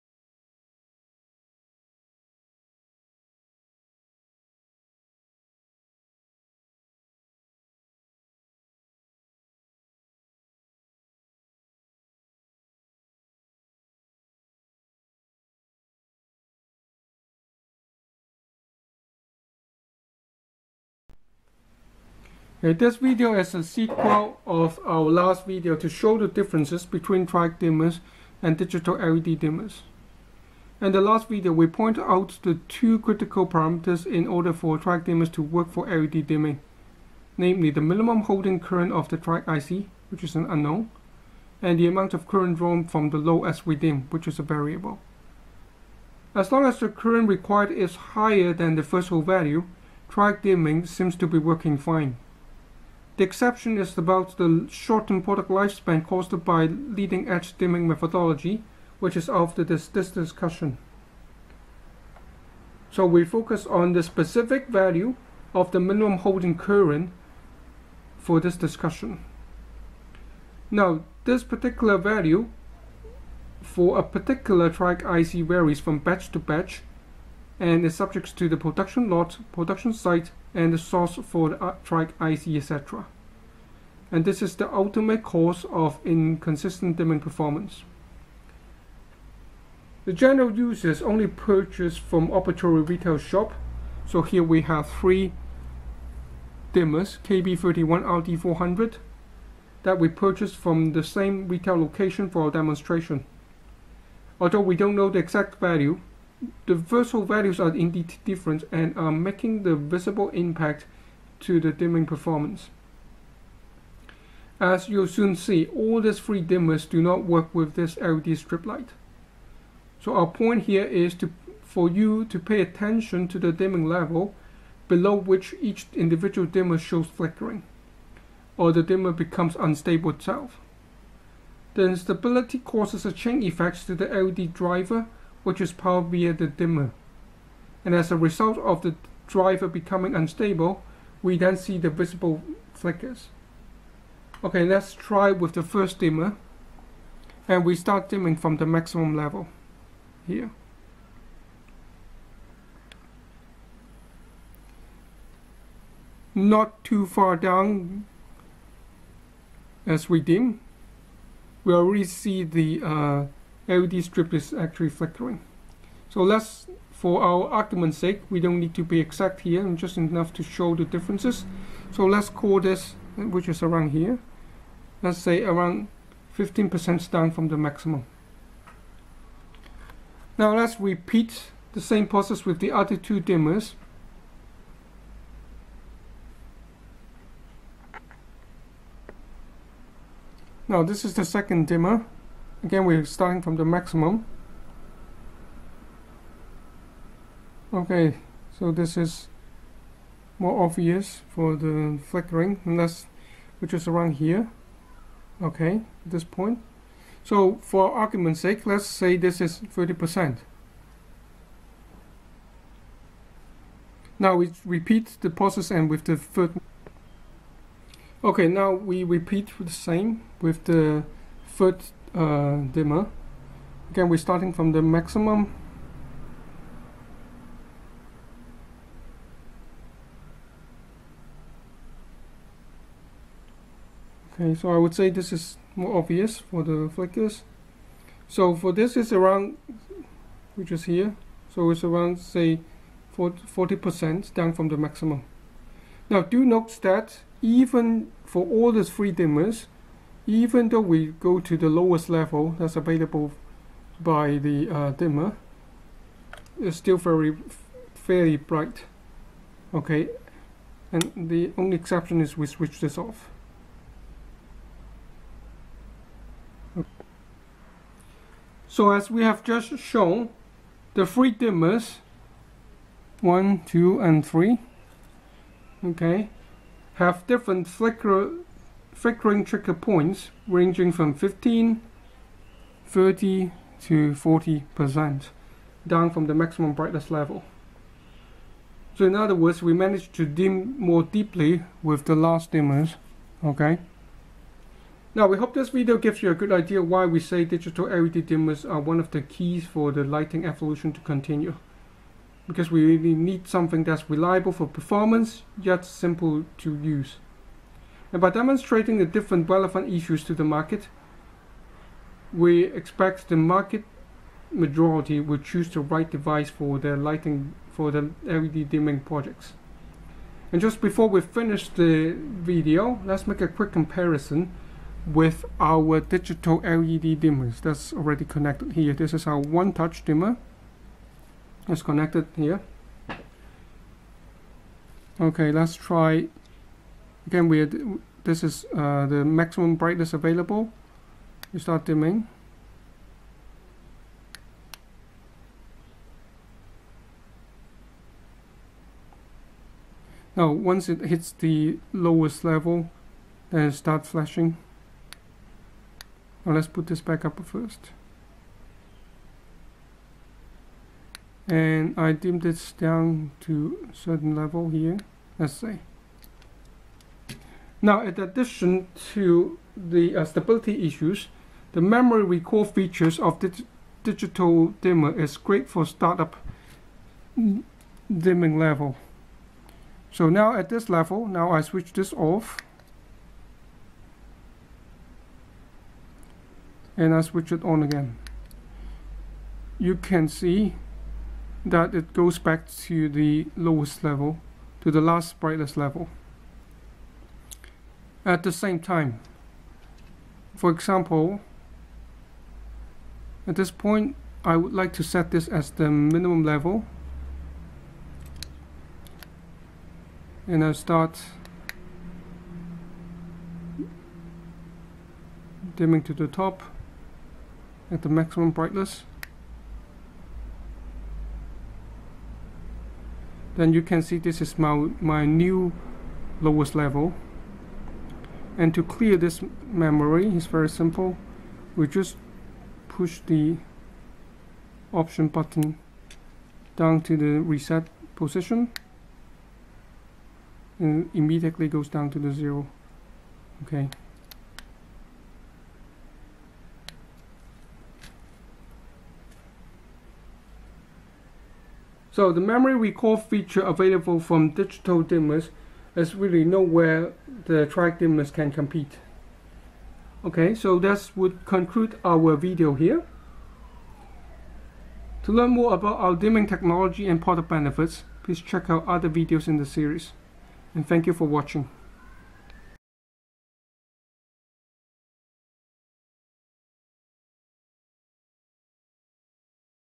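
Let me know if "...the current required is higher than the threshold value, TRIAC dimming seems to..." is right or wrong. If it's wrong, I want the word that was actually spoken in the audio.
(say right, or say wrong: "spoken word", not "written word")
right.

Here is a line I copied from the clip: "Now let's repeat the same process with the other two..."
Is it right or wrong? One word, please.
right.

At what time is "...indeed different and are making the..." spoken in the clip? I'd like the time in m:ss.
1:47.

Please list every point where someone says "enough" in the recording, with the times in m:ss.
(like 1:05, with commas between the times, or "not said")
2:49.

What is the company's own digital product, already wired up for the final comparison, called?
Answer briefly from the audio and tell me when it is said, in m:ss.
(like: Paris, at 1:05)
one-touch dimmer, at 5:29.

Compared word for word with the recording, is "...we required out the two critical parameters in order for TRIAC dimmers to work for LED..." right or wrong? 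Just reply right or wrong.
wrong.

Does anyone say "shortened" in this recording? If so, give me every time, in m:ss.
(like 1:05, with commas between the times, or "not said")
0:54.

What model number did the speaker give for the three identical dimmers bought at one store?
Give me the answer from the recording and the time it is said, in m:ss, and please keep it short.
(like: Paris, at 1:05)
KB31RD400, at 1:37.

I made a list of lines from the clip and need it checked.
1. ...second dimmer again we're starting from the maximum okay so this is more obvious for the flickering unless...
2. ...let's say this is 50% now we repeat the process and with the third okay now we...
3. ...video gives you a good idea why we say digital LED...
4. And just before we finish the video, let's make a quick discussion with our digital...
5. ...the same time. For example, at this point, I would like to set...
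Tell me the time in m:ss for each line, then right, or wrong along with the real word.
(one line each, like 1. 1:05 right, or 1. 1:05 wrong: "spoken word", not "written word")
1. 3:11 right
2. 3:28 wrong: "30", not "50"
3. 4:55 right
4. 5:20 wrong: "comparison", not "discussion"
5. 6:38 right.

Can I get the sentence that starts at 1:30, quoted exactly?
The general users only purchase from operatory retail shop.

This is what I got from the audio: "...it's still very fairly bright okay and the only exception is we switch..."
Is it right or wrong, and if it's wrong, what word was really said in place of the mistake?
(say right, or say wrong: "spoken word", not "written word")
right.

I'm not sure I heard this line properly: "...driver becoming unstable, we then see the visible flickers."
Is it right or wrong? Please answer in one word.
right.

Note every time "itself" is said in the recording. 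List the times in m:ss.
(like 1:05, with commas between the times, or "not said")
2:10.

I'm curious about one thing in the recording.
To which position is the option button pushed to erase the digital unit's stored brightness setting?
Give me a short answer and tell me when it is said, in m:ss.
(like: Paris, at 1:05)
reset position, at 7:17.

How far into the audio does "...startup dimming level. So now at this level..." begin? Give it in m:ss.
6:15.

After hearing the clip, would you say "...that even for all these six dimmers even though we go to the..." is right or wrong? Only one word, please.
wrong.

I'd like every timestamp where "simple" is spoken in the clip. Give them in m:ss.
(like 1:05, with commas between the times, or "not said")
5:05, 7:10.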